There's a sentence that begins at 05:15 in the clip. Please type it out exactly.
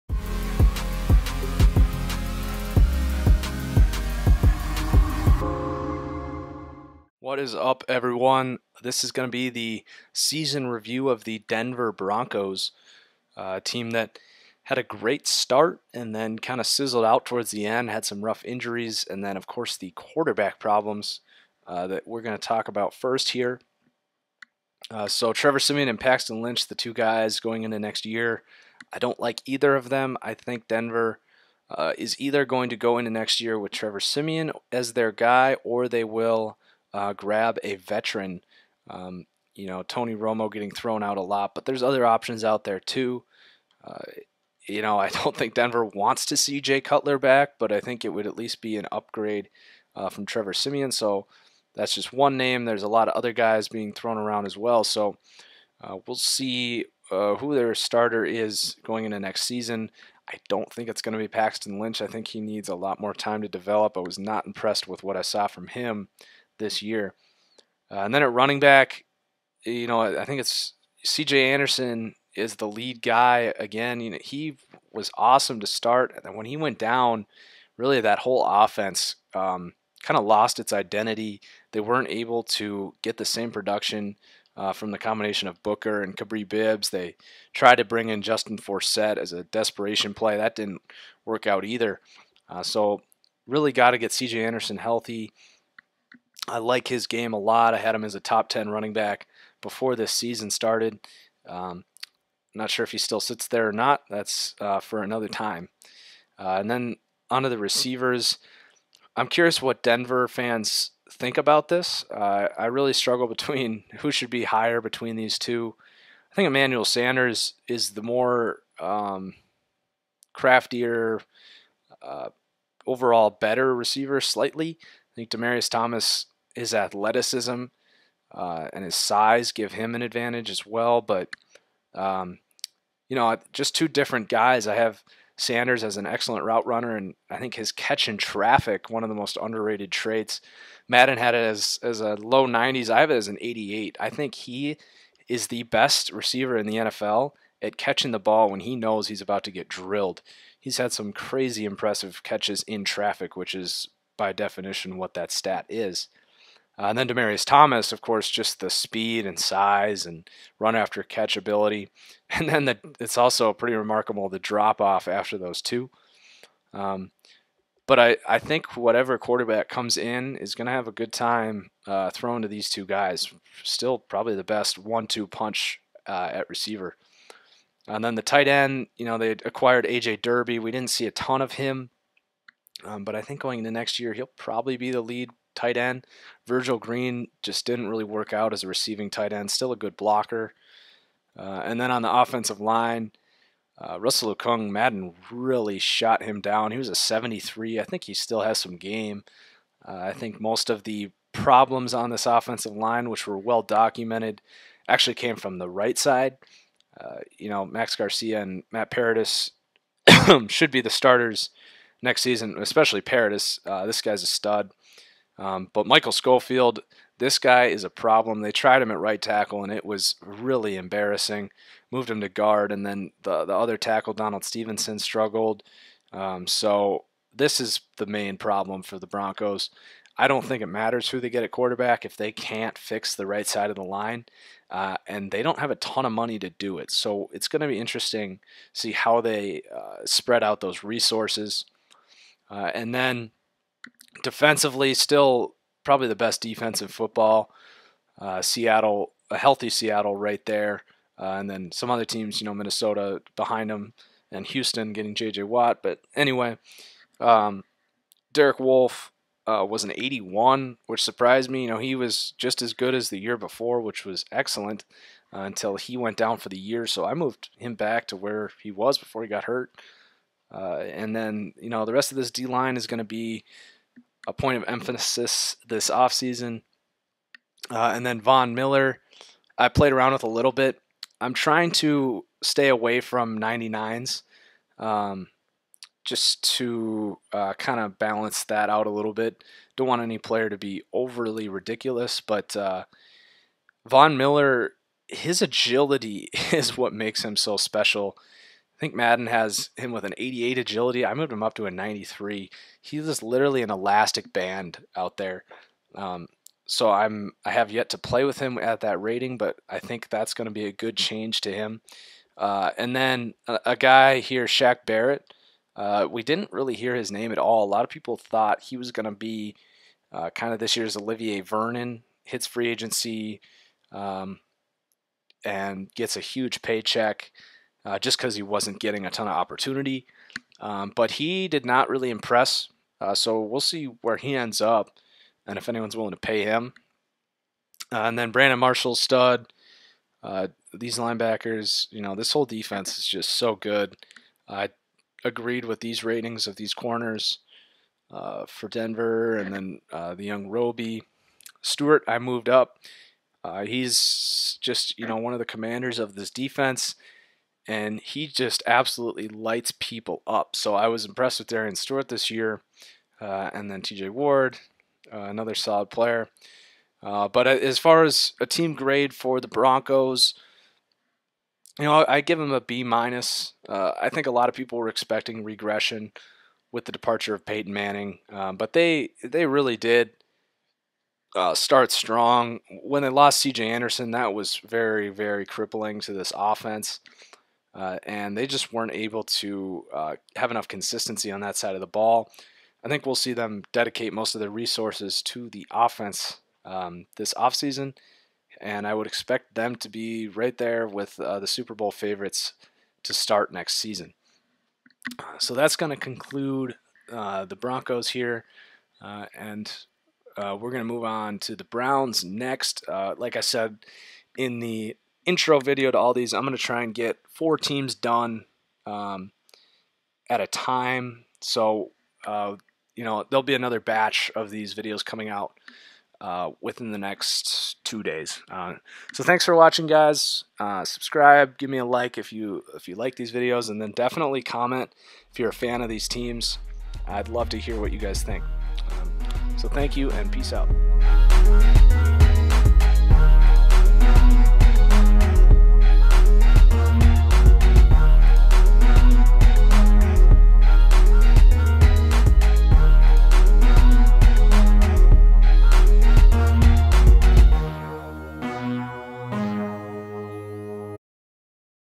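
Uh, we didn't really hear his name at all.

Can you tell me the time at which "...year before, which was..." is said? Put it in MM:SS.
04:23.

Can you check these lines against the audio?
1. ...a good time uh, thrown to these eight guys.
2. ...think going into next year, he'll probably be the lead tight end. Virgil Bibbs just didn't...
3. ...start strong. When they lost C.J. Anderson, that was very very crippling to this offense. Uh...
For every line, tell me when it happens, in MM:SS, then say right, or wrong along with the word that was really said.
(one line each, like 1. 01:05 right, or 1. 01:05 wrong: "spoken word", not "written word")
1. 02:50 wrong: "two", not "eight"
2. 03:03 wrong: "Green", not "Bibbs"
3. 06:21 right.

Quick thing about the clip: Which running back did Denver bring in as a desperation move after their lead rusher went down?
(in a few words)
Justin Forsett.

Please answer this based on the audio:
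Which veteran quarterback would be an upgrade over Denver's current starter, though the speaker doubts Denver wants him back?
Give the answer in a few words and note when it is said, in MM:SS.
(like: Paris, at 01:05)
Jay Cutler, at 00:46.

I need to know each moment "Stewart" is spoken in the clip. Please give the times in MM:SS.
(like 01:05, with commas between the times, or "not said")
05:51, 06:01.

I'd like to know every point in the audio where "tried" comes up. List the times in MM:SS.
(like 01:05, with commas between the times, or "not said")
01:27, 03:38.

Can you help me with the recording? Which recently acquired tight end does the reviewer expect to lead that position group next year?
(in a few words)
AJ Derby.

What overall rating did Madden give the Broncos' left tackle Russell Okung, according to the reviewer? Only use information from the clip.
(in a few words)
73.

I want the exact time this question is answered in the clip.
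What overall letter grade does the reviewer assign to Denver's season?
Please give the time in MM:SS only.
06:12.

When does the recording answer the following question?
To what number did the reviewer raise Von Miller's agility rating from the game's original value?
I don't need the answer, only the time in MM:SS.
05:01.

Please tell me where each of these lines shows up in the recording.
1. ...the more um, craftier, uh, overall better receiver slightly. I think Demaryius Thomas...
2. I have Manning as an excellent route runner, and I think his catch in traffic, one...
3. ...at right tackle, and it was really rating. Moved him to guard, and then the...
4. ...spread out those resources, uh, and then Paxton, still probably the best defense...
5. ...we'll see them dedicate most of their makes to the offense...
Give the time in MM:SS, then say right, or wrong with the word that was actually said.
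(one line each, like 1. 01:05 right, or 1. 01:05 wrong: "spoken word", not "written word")
1. 01:57 right
2. 02:14 wrong: "Sanders", not "Manning"
3. 03:38 wrong: "embarrassing", not "rating"
4. 04:00 wrong: "Defensively", not "Paxton"
5. 06:33 wrong: "resources", not "makes".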